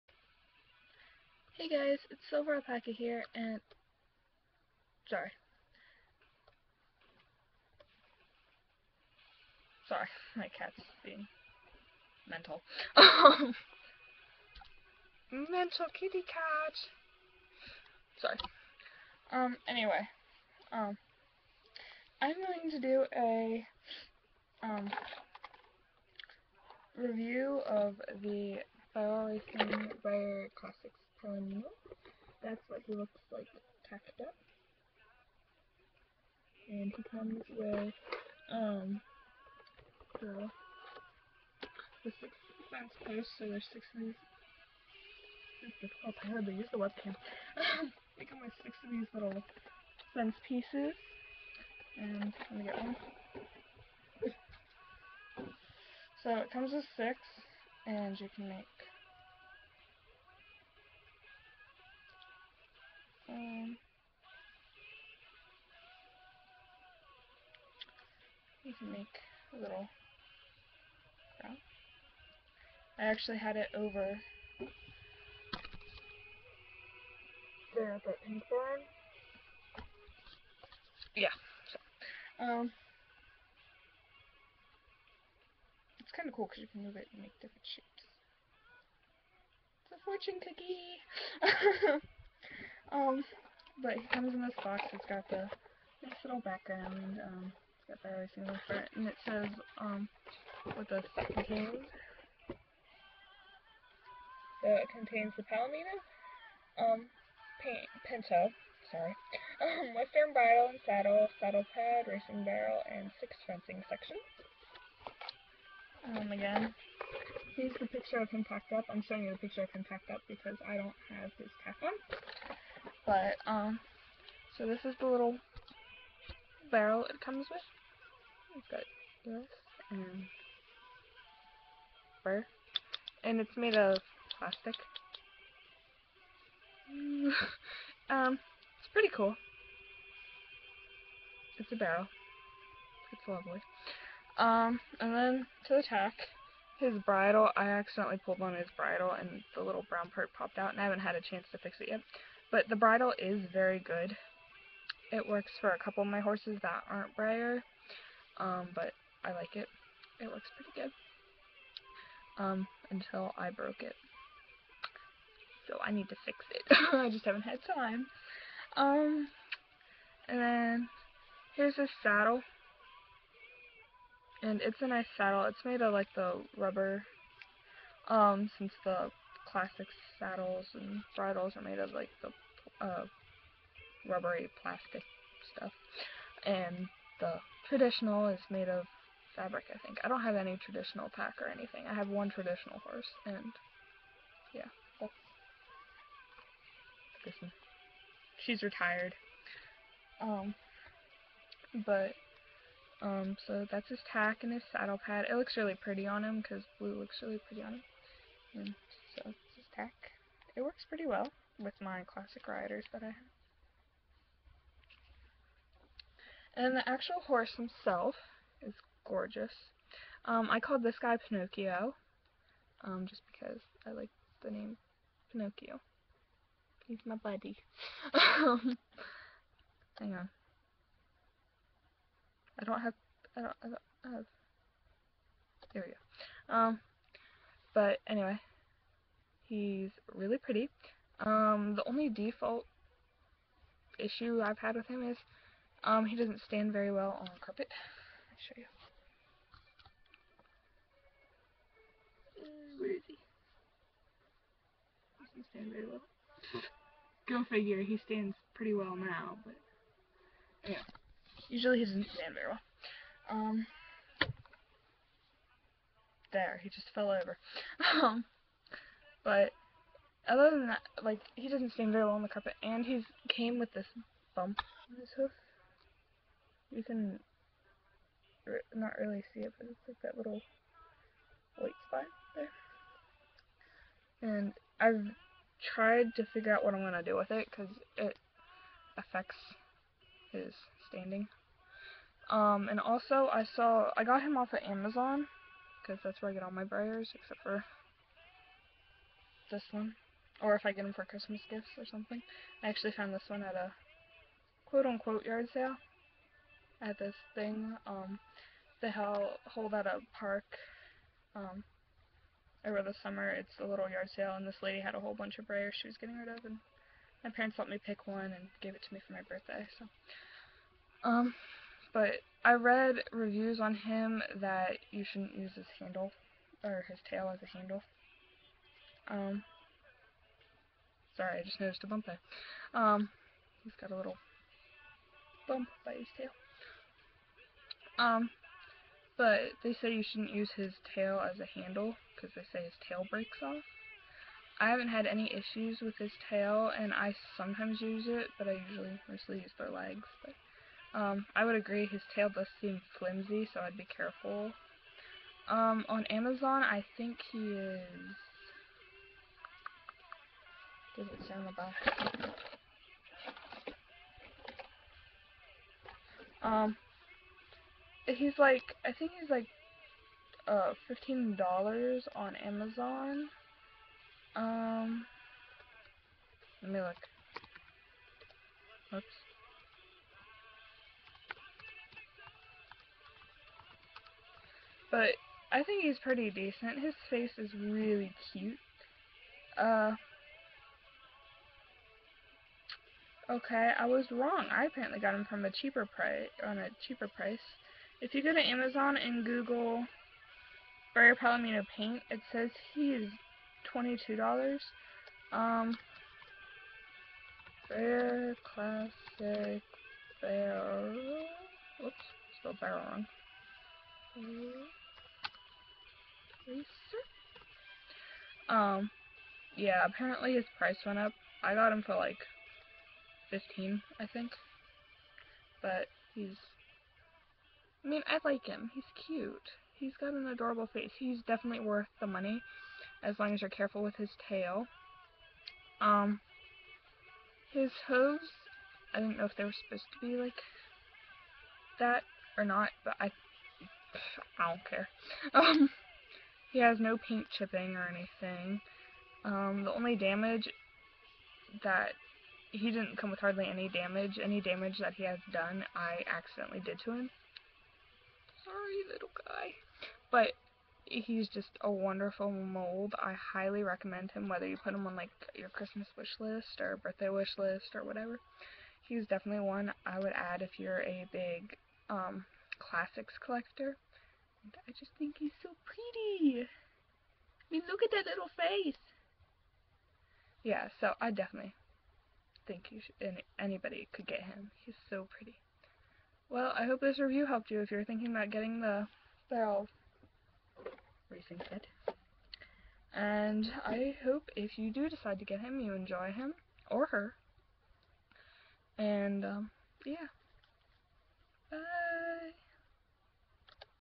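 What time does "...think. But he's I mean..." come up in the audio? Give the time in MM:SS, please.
07:04.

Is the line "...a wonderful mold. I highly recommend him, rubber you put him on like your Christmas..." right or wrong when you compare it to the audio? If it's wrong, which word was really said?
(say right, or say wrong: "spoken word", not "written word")
wrong: "whether", not "rubber".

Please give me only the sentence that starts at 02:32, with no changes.
But the bridle is very good.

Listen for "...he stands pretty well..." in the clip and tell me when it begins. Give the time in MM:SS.
04:17.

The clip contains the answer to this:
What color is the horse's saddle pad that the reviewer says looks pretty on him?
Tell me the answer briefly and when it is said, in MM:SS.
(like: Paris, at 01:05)
Blue, at 03:26.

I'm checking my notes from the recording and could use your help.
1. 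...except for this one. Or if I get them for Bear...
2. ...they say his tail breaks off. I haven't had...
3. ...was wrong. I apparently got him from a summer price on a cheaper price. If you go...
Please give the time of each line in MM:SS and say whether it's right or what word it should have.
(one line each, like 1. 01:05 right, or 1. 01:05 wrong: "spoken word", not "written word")
1. 04:57 wrong: "Christmas", not "Bear"
2. 05:42 right
3. 06:33 wrong: "cheaper", not "summer".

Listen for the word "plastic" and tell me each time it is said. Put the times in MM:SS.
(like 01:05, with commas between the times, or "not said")
02:14, 03:04.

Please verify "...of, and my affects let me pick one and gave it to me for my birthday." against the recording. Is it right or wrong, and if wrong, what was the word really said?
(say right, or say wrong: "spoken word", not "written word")
wrong: "parents", not "affects".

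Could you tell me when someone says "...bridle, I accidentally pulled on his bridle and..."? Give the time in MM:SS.
02:27.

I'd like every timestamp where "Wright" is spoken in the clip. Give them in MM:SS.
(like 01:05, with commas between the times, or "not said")
not said.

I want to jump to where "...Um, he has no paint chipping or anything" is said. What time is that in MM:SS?
07:25.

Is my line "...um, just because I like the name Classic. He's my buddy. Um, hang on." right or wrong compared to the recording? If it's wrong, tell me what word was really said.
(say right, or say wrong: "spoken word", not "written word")
wrong: "Pinocchio", not "Classic".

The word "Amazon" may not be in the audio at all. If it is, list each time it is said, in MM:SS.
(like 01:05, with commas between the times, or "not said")
04:54, 05:56, 06:12, 06:38.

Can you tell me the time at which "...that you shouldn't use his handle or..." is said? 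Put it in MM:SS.
05:24.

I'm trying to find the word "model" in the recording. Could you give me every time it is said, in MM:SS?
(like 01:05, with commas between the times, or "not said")
not said.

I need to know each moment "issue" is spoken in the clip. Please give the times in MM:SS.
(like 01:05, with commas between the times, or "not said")
04:03, 05:45.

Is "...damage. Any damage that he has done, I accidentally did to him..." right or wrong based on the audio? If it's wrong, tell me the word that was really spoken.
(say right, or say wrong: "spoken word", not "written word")
right.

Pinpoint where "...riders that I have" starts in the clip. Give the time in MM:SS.
03:32.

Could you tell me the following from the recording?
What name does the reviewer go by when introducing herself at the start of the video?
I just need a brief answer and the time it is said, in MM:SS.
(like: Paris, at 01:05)
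Silver Alpaca, at 00:02.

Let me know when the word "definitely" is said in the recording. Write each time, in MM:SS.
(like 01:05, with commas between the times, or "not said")
07:11, 07:49, 08:01.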